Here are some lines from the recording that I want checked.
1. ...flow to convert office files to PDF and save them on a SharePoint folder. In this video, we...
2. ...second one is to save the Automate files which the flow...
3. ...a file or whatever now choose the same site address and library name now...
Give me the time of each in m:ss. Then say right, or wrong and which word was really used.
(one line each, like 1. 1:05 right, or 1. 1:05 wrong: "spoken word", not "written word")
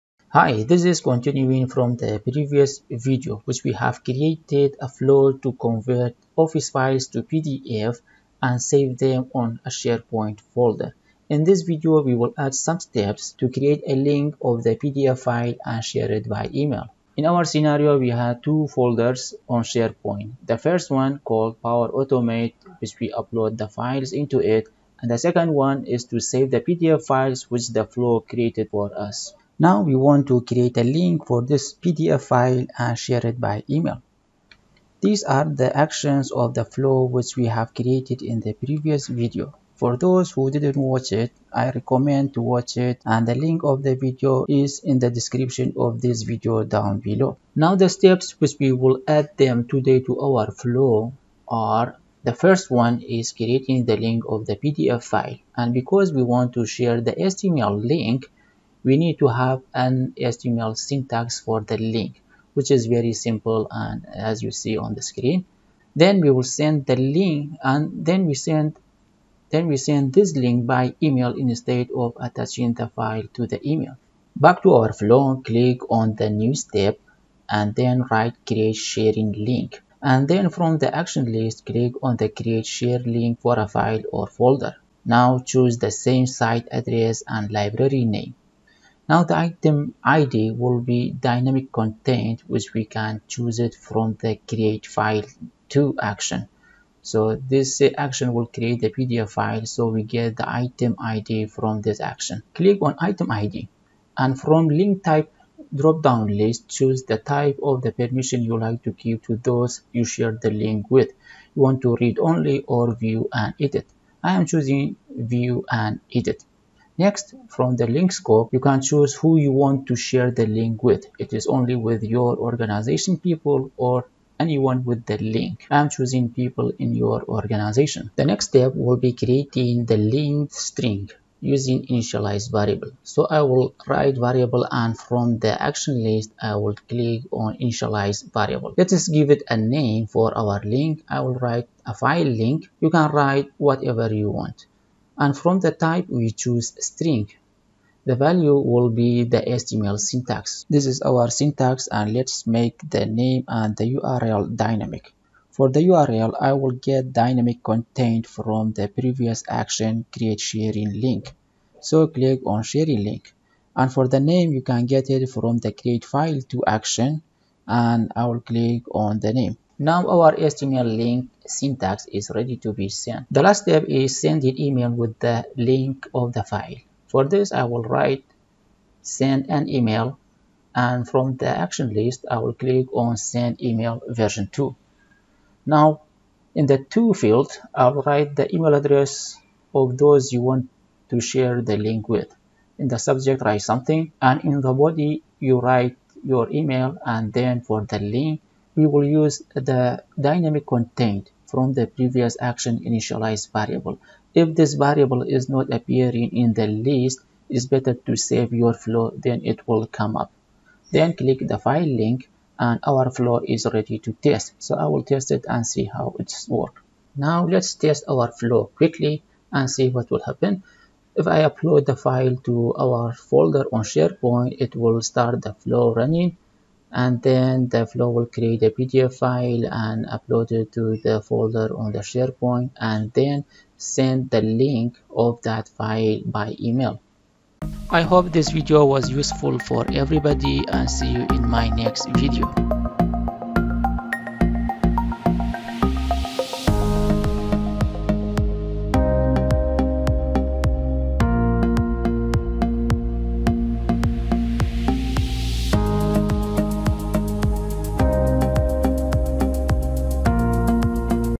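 1. 0:04 right
2. 0:25 wrong: "PDF", not "Automate"
3. 1:23 wrong: "folder", not "whatever".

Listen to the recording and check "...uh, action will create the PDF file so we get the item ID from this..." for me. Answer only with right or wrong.
right.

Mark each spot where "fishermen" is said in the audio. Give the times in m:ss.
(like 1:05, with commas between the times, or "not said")
not said.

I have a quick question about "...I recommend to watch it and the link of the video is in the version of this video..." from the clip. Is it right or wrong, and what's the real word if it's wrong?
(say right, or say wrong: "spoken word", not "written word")
wrong: "description", not "version".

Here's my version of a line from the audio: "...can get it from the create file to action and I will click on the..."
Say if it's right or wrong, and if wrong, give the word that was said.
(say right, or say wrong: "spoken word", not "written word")
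right.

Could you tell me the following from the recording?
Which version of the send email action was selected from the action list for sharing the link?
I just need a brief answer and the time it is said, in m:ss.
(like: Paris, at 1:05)
Version 2, at 3:04.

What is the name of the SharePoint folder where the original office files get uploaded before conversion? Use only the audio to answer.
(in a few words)
Power Automate.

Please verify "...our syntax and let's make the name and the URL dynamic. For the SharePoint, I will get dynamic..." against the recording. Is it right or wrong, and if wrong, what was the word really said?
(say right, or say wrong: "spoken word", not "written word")
wrong: "URL", not "SharePoint".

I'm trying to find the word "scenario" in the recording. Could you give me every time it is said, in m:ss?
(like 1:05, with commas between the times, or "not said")
0:17.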